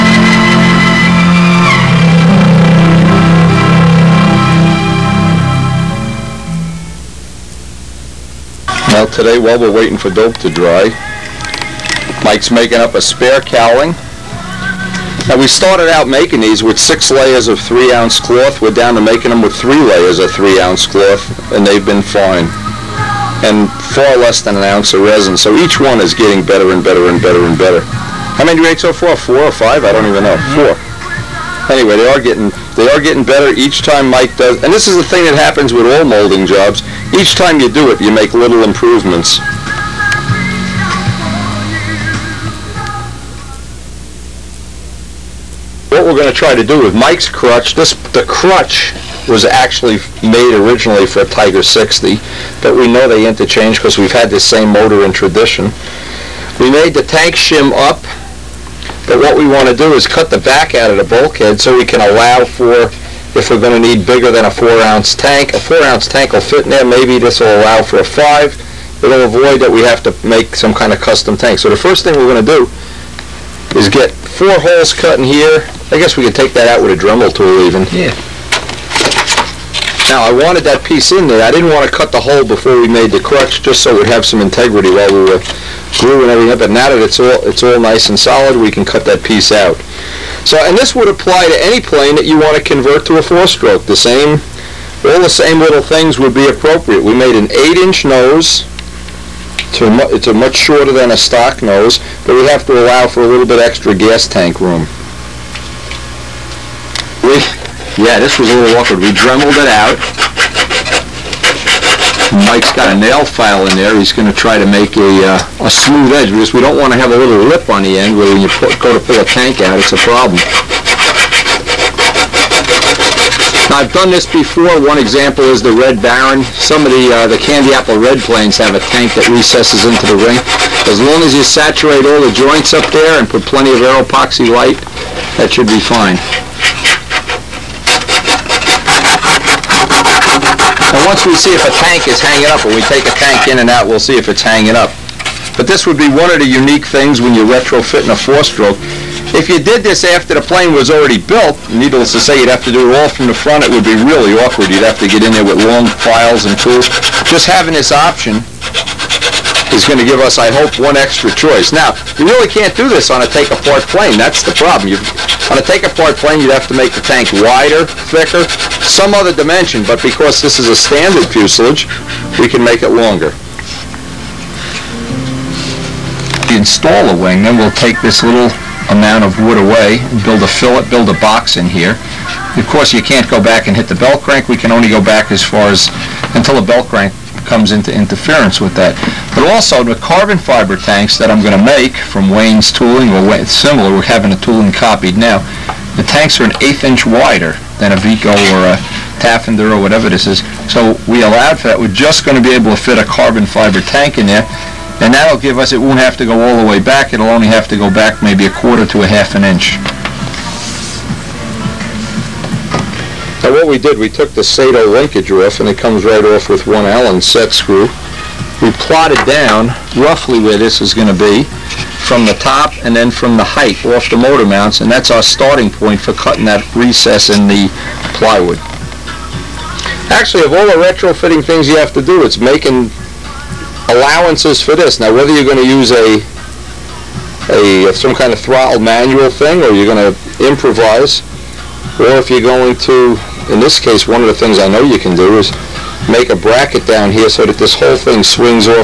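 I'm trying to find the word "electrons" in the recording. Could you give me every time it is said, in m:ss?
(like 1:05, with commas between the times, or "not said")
not said.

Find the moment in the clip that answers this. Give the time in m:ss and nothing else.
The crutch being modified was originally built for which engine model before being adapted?
0:51.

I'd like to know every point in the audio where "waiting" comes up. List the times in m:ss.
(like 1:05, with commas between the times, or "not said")
0:09.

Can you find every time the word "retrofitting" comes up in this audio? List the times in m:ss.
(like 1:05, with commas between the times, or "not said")
2:27, 3:50.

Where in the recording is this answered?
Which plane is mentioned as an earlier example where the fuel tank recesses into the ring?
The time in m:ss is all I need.
2:05.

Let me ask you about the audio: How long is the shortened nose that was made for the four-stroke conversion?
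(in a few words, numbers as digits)
8 inches.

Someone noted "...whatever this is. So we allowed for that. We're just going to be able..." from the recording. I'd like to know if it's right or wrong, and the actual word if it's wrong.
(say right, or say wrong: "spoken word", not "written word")
right.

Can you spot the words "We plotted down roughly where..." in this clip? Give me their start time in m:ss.
3:38.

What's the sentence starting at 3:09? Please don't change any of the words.
But also the carbon fiber tanks that I'm going to make from Wayne's tooling or similar, we're having a tooling copied now.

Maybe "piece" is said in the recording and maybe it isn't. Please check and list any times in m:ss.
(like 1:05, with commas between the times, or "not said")
1:20, 1:29.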